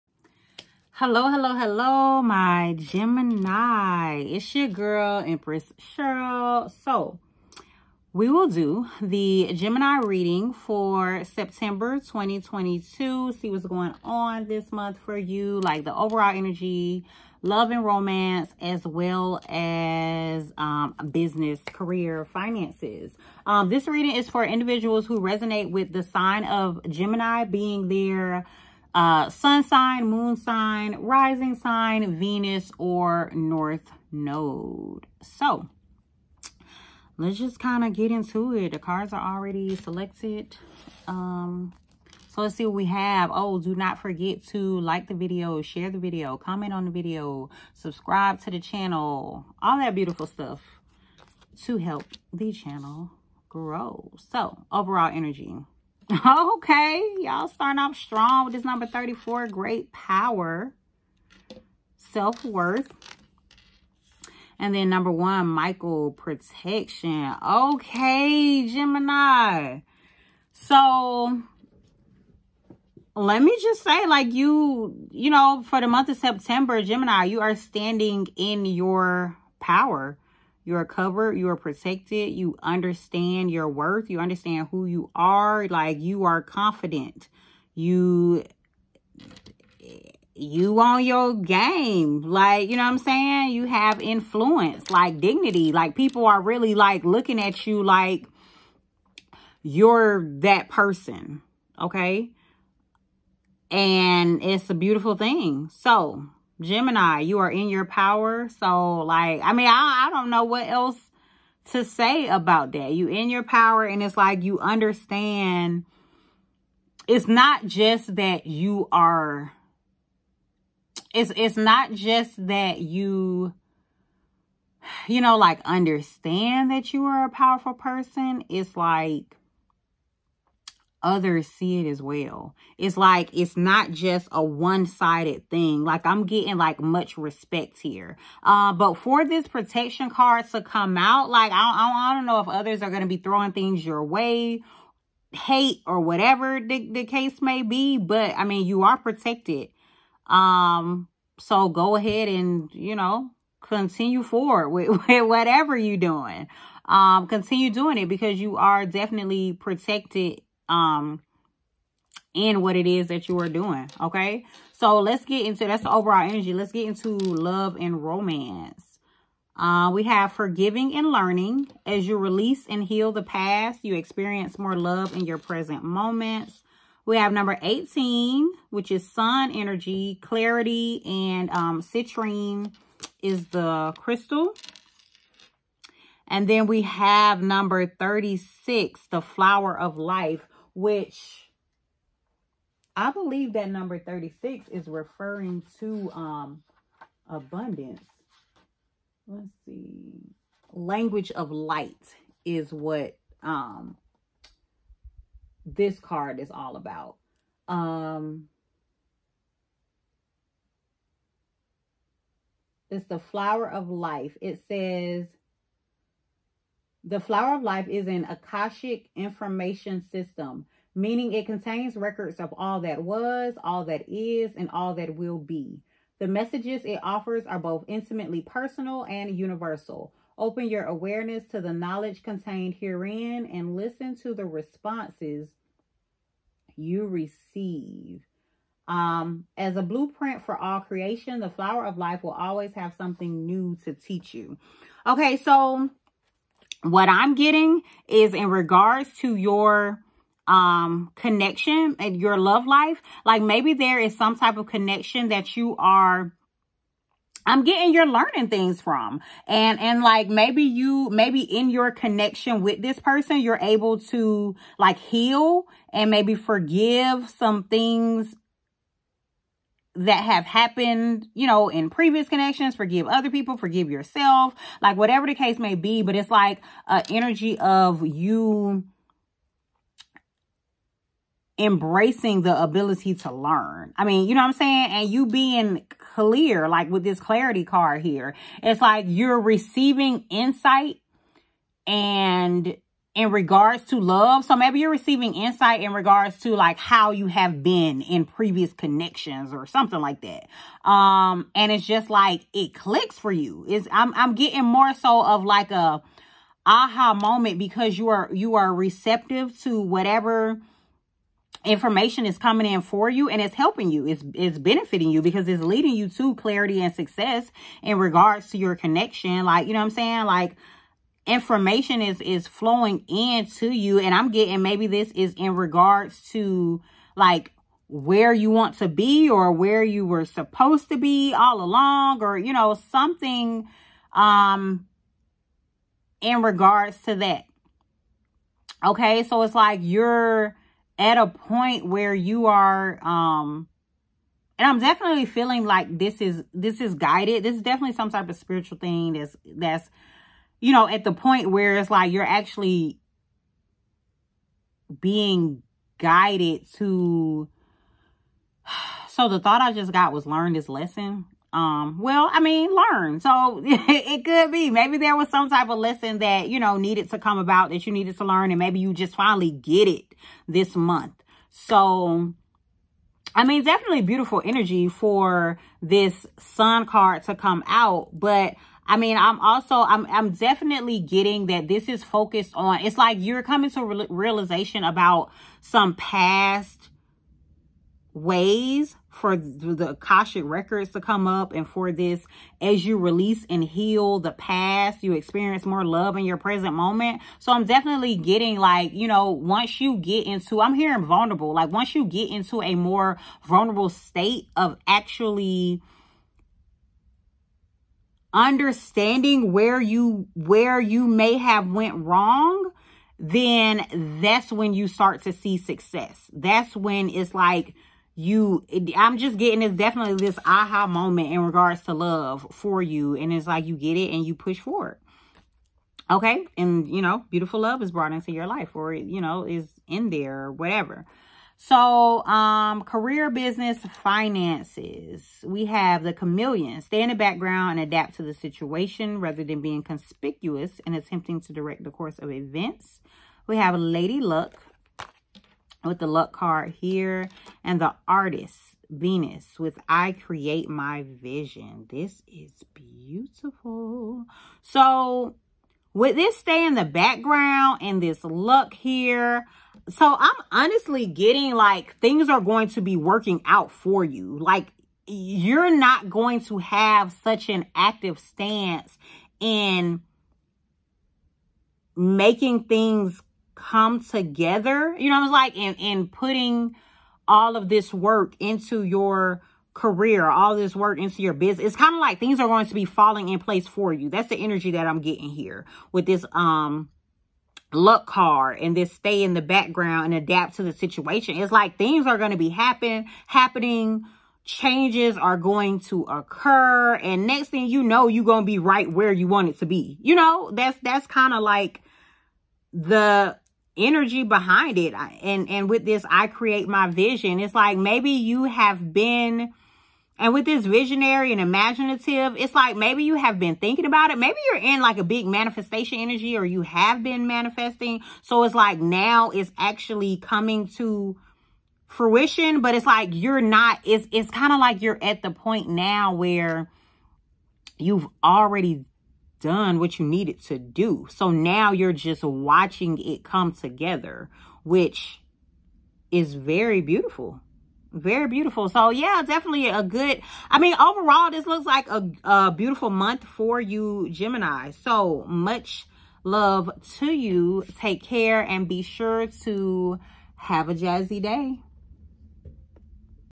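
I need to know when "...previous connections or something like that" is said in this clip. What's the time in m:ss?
4:58.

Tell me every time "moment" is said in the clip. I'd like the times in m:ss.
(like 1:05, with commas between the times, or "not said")
2:55, 5:07, 6:36, 7:00.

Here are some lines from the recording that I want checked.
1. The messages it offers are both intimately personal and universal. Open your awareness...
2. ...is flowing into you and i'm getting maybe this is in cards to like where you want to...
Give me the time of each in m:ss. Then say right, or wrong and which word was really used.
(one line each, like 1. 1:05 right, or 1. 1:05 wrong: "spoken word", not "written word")
1. 3:46 right
2. 5:22 wrong: "regards", not "cards".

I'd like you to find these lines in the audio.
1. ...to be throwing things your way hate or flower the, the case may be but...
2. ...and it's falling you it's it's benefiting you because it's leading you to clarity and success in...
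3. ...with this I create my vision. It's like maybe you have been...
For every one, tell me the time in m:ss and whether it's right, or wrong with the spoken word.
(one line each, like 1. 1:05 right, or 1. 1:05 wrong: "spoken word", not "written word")
1. 2:23 wrong: "whatever", not "flower"
2. 5:13 wrong: "helping", not "falling"
3. 8:25 right.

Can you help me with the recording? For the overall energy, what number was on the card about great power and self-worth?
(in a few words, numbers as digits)
34.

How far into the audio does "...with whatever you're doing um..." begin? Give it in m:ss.
2:35.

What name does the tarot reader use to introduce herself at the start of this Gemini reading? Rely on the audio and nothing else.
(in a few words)
Empress Cheryl.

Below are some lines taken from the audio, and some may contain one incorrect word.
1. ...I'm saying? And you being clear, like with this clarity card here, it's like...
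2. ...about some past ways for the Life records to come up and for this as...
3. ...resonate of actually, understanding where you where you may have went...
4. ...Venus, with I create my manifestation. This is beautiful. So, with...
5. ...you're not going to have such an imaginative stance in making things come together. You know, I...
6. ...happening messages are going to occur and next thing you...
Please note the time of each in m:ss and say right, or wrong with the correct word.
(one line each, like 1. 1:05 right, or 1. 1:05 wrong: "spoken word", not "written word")
1. 4:44 right
2. 6:24 wrong: "Akashic", not "Life"
3. 6:43 wrong: "state", not "resonate"
4. 7:28 wrong: "vision", not "manifestation"
5. 7:45 wrong: "active", not "imaginative"
6. 8:13 wrong: "changes", not "messages".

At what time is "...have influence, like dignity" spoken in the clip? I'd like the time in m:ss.
1:33.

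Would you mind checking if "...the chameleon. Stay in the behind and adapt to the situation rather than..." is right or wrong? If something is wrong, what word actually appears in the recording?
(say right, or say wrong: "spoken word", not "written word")
wrong: "background", not "behind".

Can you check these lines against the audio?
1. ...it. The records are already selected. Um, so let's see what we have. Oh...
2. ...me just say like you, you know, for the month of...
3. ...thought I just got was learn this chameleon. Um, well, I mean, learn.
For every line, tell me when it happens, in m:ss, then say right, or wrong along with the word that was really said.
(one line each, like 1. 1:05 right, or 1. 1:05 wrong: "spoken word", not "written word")
1. 0:38 wrong: "cards", not "records"
2. 1:13 right
3. 5:59 wrong: "lesson", not "chameleon".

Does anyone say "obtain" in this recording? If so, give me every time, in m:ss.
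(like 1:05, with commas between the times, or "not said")
not said.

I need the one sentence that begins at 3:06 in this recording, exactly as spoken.
And then we have number 36, the flower of life, which I believe that number 36 is referring to um, abundance.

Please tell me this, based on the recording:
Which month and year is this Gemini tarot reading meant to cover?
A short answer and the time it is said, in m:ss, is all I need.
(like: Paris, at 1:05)
September 2022, at 0:11.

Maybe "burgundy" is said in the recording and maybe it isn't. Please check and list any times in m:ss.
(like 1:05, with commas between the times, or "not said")
not said.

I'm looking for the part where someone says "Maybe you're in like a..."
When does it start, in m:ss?
8:34.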